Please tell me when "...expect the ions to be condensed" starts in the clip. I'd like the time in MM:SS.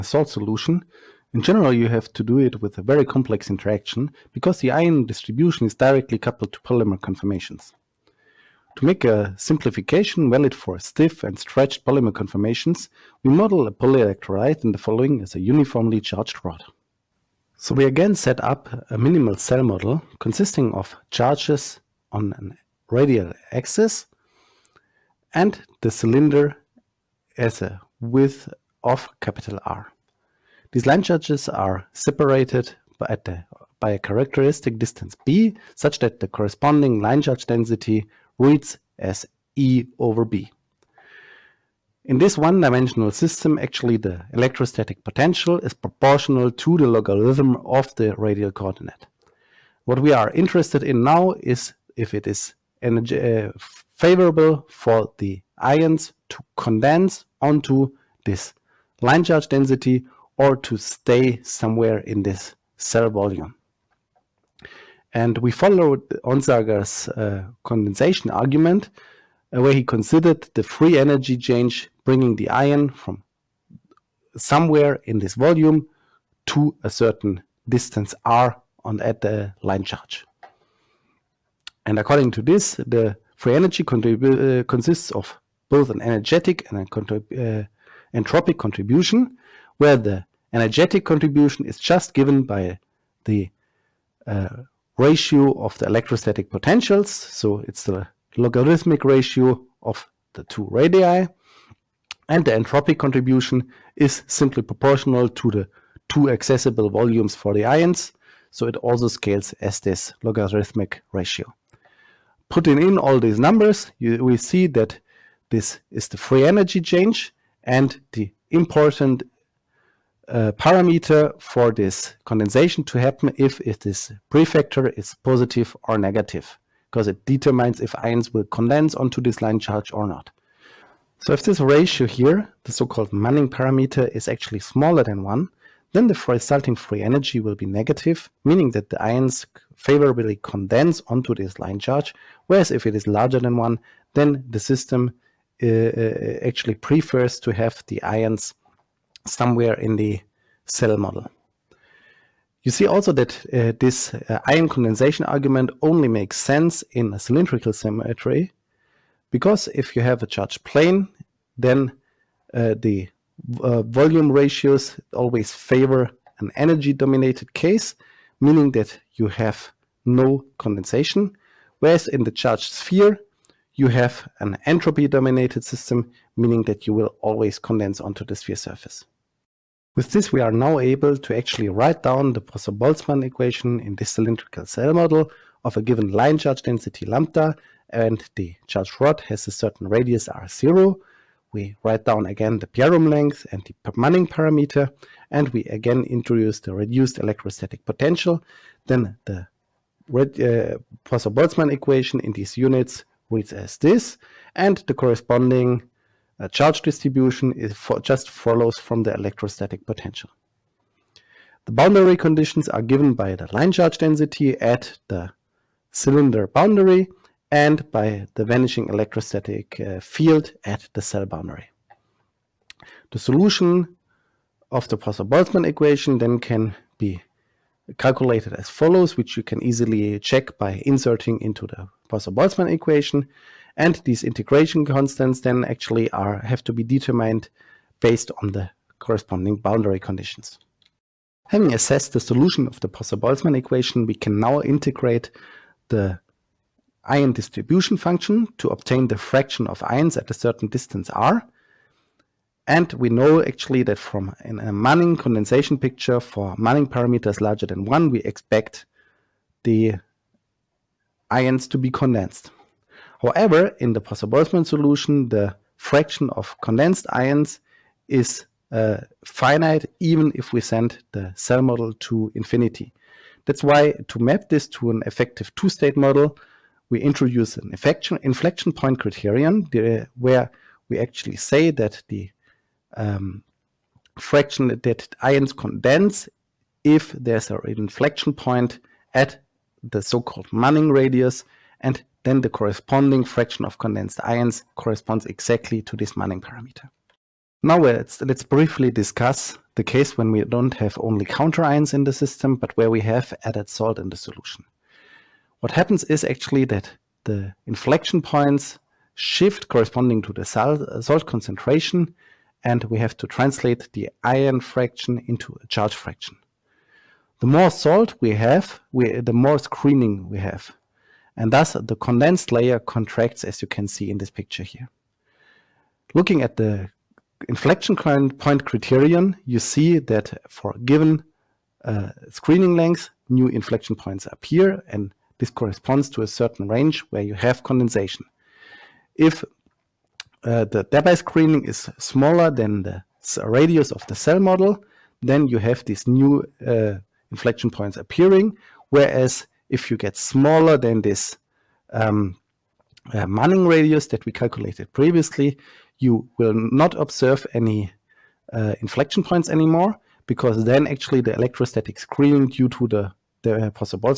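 04:18.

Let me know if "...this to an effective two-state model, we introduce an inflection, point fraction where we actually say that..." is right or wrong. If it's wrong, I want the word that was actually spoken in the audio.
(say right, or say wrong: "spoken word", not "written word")
wrong: "criterion", not "fraction".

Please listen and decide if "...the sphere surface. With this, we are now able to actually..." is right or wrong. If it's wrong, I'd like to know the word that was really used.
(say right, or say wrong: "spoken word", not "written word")
right.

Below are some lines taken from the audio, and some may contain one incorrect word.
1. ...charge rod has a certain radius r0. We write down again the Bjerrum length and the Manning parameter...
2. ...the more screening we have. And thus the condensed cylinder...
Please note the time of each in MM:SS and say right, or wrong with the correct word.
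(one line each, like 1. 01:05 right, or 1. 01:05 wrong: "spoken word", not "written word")
1. 03:08 right
2. 05:19 wrong: "layer", not "cylinder".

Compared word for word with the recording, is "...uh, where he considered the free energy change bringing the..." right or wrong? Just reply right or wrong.
right.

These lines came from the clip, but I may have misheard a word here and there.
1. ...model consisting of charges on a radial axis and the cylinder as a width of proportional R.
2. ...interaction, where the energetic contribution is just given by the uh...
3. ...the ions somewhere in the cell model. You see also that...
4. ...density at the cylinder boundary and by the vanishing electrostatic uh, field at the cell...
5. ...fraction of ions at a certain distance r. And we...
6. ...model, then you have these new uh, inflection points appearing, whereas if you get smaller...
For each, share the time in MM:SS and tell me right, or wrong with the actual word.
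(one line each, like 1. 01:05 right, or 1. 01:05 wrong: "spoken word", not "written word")
1. 00:19 wrong: "capital", not "proportional"
2. 01:28 wrong: "contribution", not "interaction"
3. 02:27 right
4. 03:33 right
5. 04:09 right
6. 05:44 right.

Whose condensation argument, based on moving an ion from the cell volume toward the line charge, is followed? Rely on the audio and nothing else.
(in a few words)
Onsager.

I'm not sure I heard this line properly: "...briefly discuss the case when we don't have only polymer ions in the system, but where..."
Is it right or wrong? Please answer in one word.
wrong.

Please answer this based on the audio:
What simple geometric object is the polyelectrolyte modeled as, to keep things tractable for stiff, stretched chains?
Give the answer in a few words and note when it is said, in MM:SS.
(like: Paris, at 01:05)
Uniformly charged rod, at 00:15.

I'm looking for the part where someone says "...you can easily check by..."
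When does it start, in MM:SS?
03:49.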